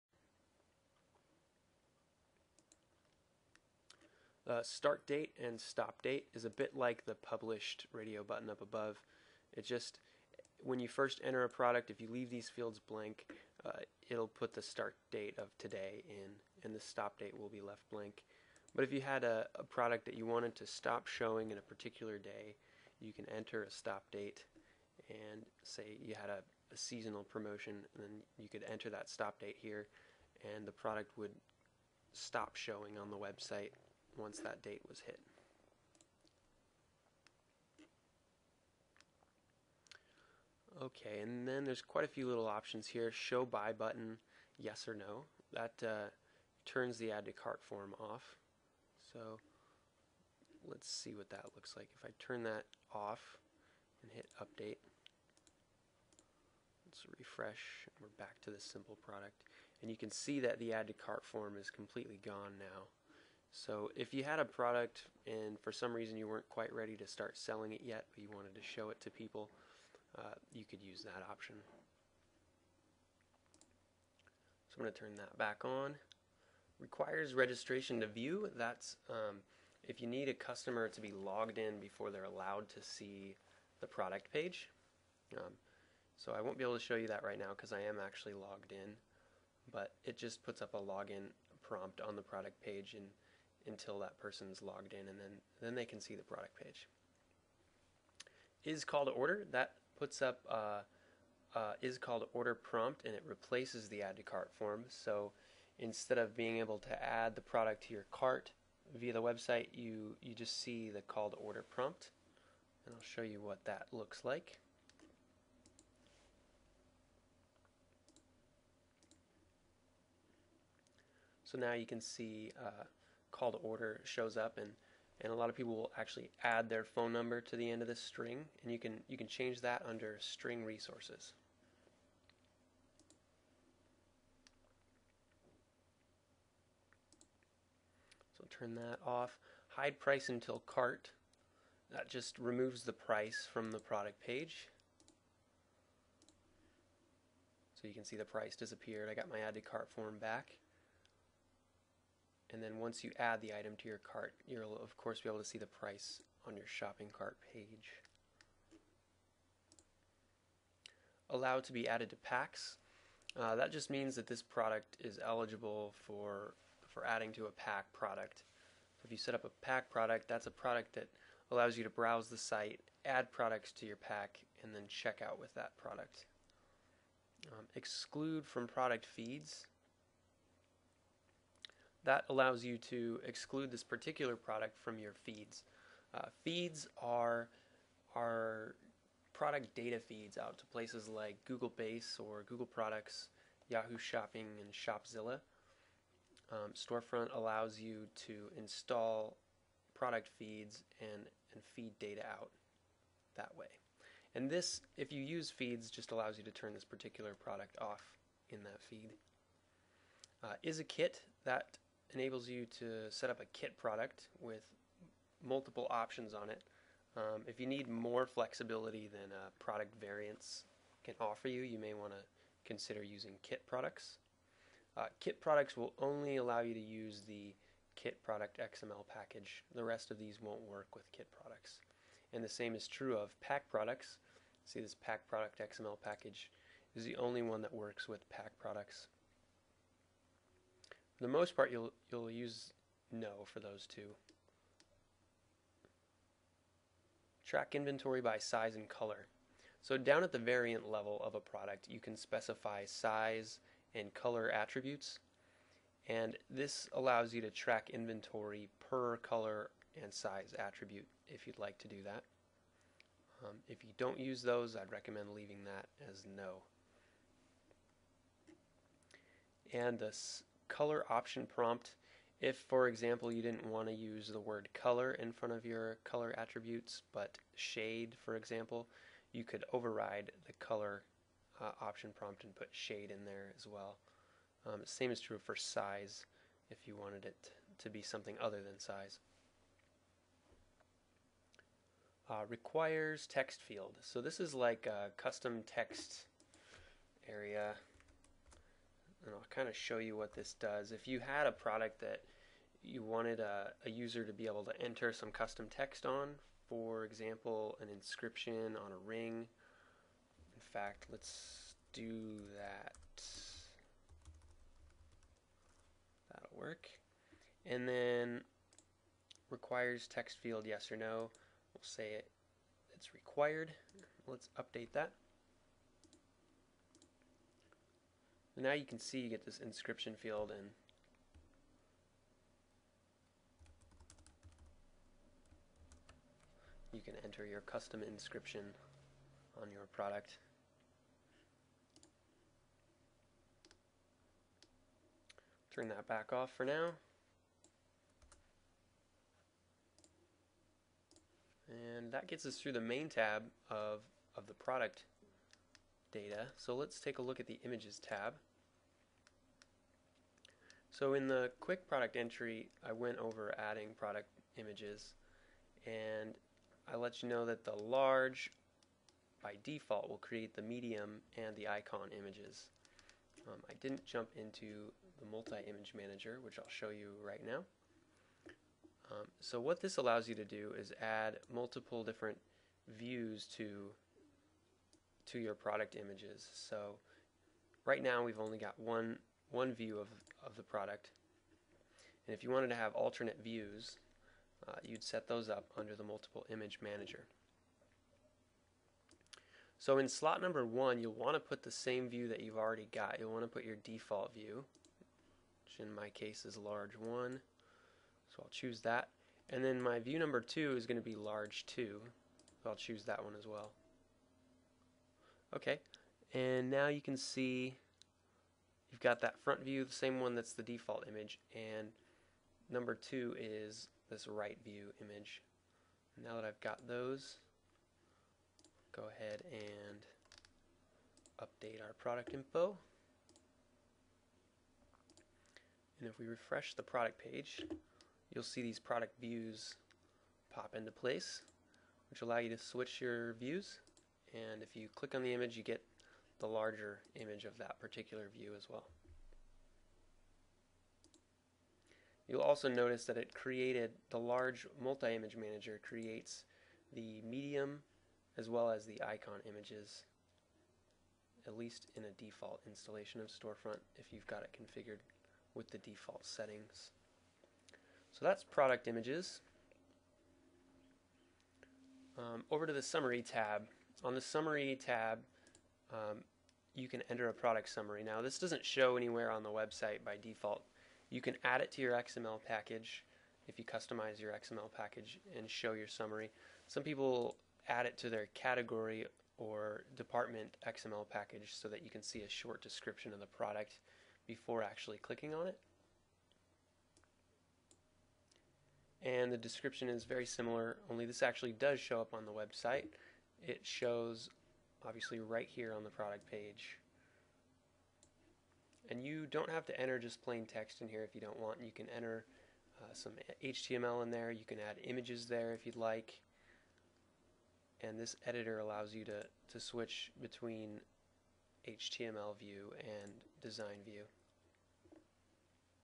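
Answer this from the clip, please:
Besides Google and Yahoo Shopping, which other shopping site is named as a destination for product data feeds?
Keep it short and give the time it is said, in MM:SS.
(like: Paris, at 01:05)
Shopzilla, at 03:14.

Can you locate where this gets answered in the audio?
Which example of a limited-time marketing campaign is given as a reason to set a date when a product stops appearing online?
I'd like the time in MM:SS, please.
00:26.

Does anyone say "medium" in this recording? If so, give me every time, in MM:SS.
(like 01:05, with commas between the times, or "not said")
06:10, 07:37.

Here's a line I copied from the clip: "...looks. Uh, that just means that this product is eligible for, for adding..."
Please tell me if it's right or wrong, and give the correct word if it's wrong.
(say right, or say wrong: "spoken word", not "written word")
wrong: "packs", not "looks".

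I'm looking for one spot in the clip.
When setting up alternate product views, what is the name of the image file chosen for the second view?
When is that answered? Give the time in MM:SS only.
06:51.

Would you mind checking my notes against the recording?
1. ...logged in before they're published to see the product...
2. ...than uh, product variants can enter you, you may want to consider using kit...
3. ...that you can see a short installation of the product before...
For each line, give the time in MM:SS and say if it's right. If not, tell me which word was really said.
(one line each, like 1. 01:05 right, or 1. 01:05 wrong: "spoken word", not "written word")
1. 01:21 wrong: "allowed", not "published"
2. 03:39 wrong: "offer", not "enter"
3. 08:11 wrong: "description", not "installation".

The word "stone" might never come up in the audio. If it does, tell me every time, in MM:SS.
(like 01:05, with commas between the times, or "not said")
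not said.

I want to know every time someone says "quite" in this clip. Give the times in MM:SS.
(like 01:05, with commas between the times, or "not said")
00:41, 01:06.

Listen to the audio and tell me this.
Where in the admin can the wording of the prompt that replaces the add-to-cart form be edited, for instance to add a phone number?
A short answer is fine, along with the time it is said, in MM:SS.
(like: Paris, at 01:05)
string resources, at 02:10.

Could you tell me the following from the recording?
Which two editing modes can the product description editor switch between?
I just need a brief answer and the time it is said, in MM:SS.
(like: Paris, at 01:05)
HTML view and design view, at 08:41.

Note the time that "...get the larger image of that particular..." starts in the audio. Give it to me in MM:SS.
07:25.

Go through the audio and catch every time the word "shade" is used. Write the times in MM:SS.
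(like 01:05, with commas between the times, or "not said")
04:37, 04:42.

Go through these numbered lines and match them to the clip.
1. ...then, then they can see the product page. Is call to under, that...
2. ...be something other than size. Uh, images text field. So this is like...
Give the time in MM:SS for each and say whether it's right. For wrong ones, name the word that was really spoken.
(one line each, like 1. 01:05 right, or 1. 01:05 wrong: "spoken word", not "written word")
1. 01:35 wrong: "order", not "under"
2. 04:47 wrong: "requires", not "images".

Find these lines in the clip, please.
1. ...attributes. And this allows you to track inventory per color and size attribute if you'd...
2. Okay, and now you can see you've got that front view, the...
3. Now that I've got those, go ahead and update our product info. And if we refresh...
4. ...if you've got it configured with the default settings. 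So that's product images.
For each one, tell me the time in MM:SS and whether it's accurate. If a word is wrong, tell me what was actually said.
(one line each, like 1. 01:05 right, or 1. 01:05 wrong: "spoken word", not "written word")
1. 04:14 right
2. 06:55 right
3. 07:06 right
4. 07:43 right.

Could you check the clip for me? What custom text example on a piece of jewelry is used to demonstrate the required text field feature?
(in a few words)
an inscription on a ring.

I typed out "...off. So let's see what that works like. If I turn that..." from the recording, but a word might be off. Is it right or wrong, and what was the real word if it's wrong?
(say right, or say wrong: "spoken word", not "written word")
wrong: "looks", not "works".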